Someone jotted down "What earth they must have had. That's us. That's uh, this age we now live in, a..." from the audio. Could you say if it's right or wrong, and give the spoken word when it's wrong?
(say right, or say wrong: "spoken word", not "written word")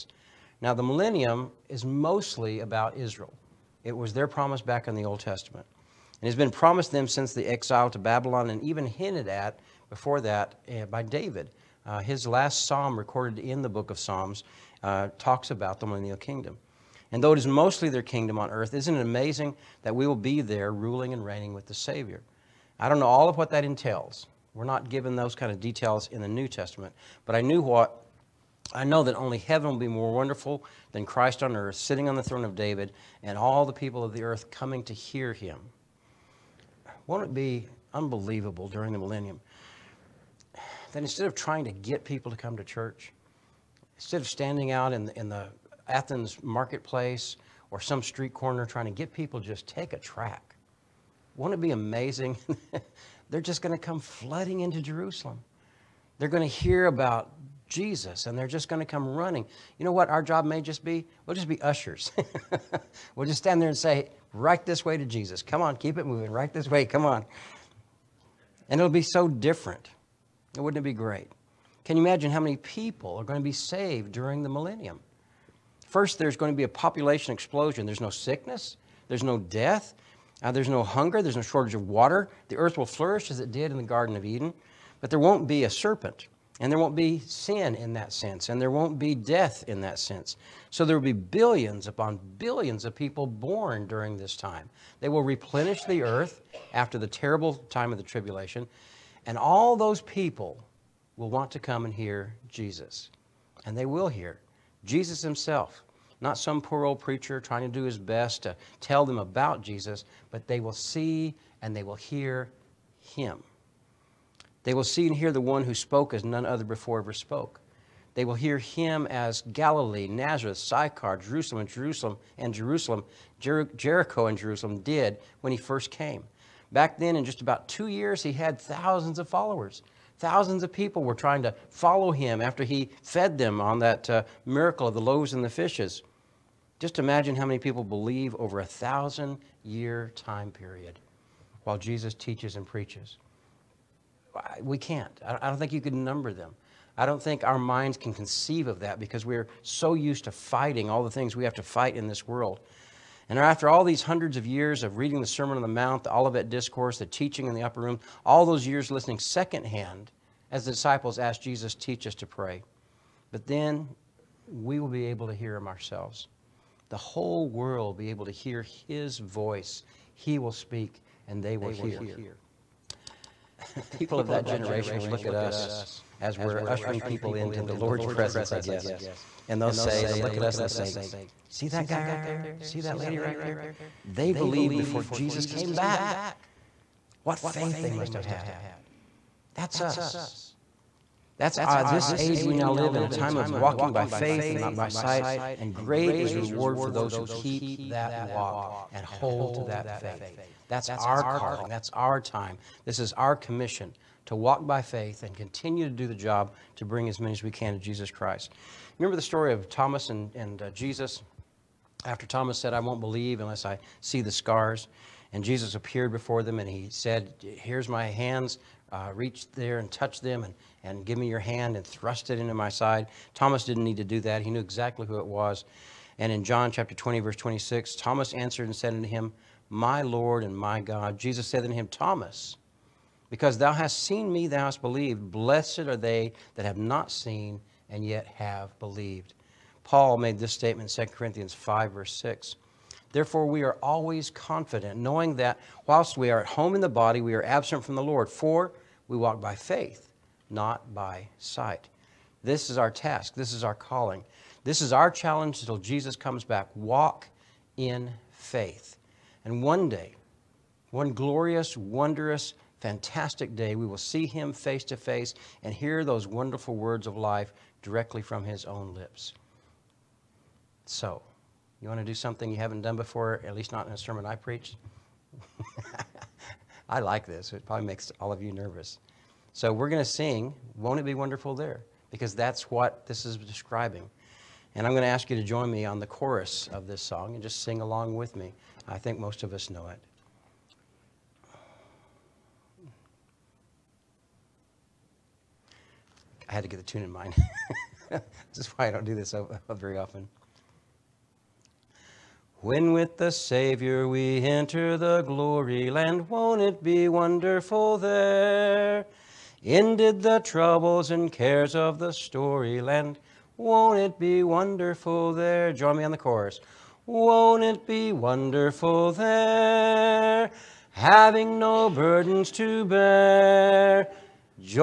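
wrong: "faith", not "earth".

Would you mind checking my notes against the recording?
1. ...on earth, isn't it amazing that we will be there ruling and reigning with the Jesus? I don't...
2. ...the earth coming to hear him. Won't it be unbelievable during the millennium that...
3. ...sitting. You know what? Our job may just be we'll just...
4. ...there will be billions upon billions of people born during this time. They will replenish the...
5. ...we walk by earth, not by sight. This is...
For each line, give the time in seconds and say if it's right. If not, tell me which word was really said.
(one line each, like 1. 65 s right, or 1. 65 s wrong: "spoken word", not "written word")
1. 18 s wrong: "Savior", not "Jesus"
2. 34 s right
3. 59 s wrong: "running", not "sitting"
4. 90 s right
5. 249 s wrong: "faith", not "earth".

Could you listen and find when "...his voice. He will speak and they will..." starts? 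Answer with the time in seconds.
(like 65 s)
168 s.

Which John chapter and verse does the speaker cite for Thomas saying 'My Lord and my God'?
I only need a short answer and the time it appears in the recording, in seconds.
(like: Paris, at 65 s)
John 20:26, at 226 s.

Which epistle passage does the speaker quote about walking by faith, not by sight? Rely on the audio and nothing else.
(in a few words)
2 Corinthians 5:6.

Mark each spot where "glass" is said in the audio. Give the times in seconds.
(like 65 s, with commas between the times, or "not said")
not said.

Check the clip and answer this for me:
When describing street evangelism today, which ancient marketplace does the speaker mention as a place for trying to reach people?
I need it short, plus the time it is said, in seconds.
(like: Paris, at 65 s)
Athens, at 45 s.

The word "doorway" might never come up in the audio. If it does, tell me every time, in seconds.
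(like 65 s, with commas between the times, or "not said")
not said.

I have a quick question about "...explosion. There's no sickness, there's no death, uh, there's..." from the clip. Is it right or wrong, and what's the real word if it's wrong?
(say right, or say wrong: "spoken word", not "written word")
right.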